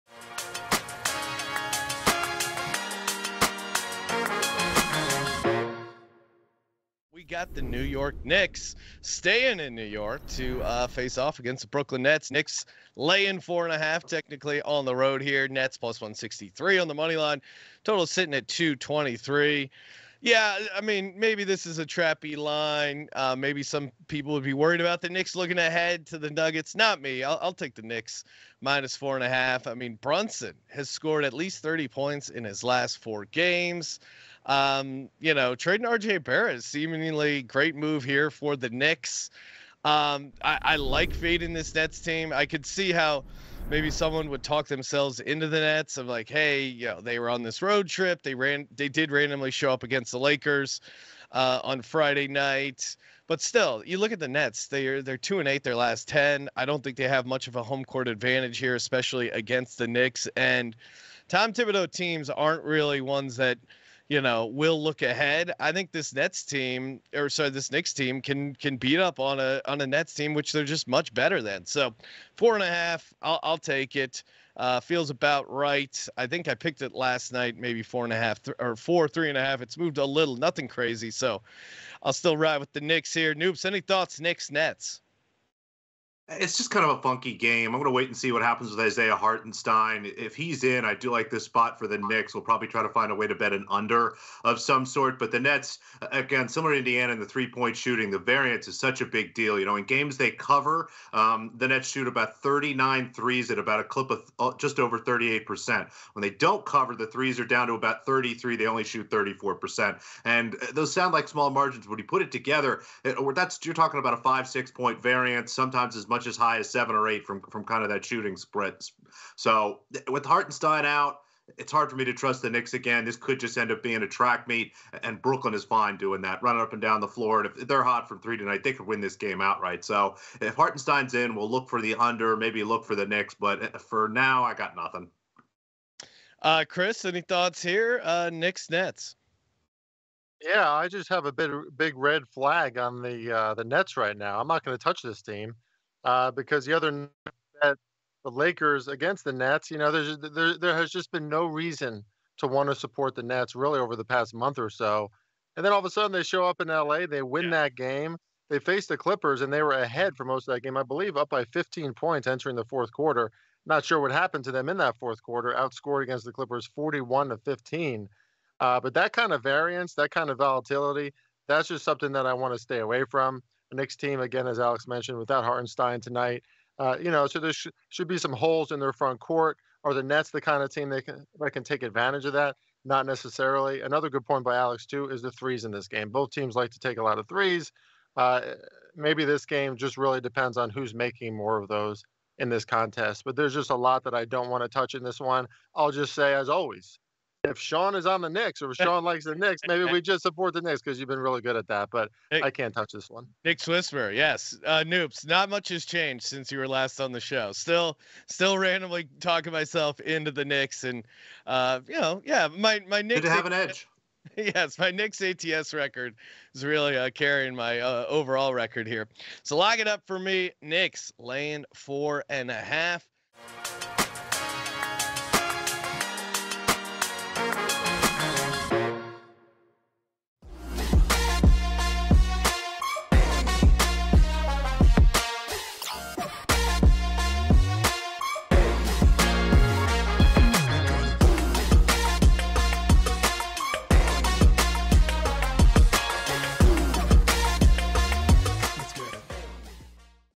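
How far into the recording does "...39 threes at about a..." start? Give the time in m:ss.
1:42.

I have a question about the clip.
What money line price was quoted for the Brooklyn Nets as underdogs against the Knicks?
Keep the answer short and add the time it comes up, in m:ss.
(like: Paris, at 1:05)
+163, at 0:15.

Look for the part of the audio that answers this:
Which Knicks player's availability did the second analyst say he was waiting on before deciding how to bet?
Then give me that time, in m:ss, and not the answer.
1:28.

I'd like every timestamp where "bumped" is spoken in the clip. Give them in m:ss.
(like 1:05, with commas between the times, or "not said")
not said.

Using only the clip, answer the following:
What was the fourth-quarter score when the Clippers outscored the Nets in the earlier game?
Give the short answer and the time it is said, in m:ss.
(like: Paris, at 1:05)
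41 to 15, at 2:46.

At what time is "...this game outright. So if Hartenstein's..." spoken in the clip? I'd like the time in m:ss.
2:09.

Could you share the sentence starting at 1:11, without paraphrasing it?
So, four and a half, I'll, I'll take it.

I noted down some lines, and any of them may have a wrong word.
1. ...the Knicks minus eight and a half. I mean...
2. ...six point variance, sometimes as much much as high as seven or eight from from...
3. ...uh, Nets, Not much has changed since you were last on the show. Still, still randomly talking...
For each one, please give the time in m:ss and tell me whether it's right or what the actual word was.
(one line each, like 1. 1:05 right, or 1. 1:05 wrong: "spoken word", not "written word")
1. 0:27 wrong: "four", not "eight"
2. 1:54 right
3. 3:24 wrong: "Noops", not "Nets".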